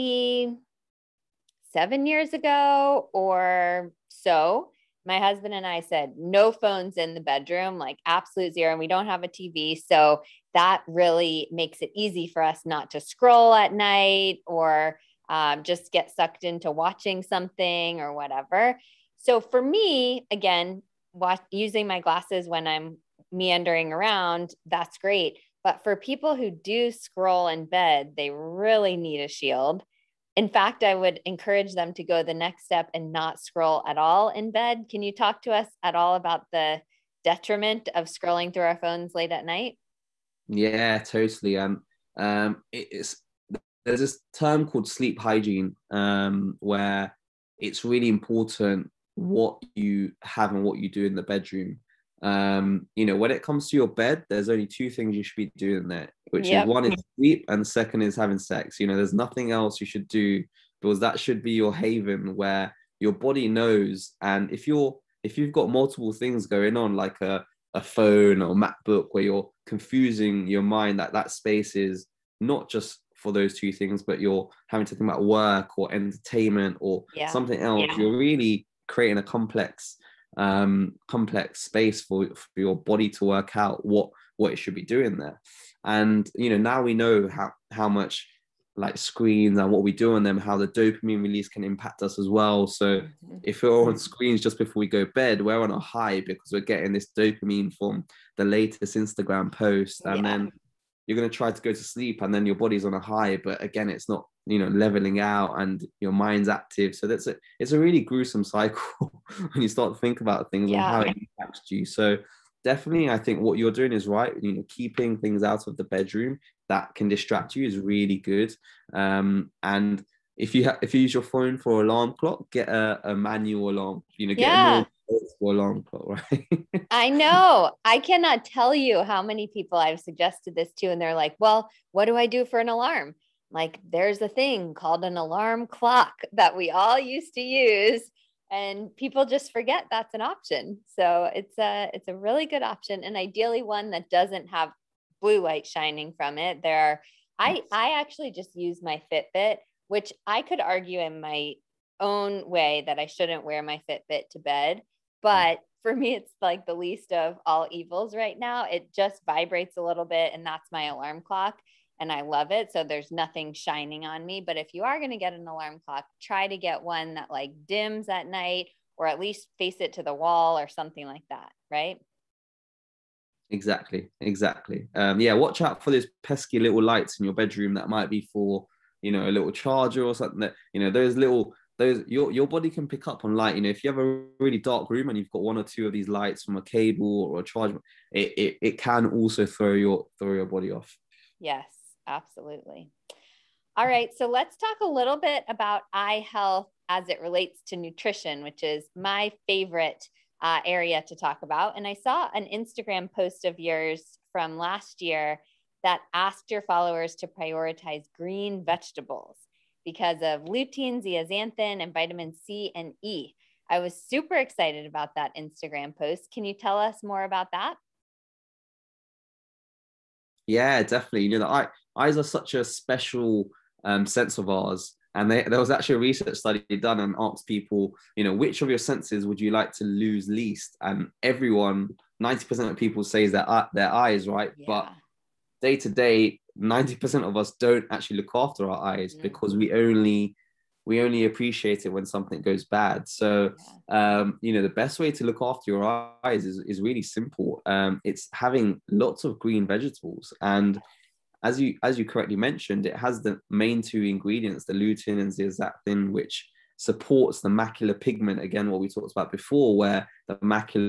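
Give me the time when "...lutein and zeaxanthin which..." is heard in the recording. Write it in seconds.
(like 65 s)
254 s.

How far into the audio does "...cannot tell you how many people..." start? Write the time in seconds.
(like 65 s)
127 s.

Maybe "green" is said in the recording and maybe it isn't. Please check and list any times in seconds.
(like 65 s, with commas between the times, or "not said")
208 s, 249 s.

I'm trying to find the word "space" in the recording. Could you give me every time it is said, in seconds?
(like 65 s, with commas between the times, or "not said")
71 s, 81 s.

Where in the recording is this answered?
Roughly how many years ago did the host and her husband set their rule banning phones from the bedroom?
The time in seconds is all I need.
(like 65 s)
1 s.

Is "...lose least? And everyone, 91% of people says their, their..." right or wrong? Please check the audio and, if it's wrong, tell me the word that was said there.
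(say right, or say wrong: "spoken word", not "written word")
wrong: "90", not "91".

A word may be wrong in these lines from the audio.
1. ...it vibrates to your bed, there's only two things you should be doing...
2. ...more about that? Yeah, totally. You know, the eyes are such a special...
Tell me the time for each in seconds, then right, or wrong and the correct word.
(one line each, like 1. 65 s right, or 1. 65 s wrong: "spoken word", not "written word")
1. 53 s wrong: "comes", not "vibrates"
2. 217 s wrong: "definitely", not "totally".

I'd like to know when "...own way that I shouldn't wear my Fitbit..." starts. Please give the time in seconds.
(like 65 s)
152 s.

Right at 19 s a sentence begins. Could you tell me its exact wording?
So for me, again, watch, using my glasses when I'm meandering around, that's great.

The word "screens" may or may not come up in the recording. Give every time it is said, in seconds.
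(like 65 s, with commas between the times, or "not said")
88 s, 93 s.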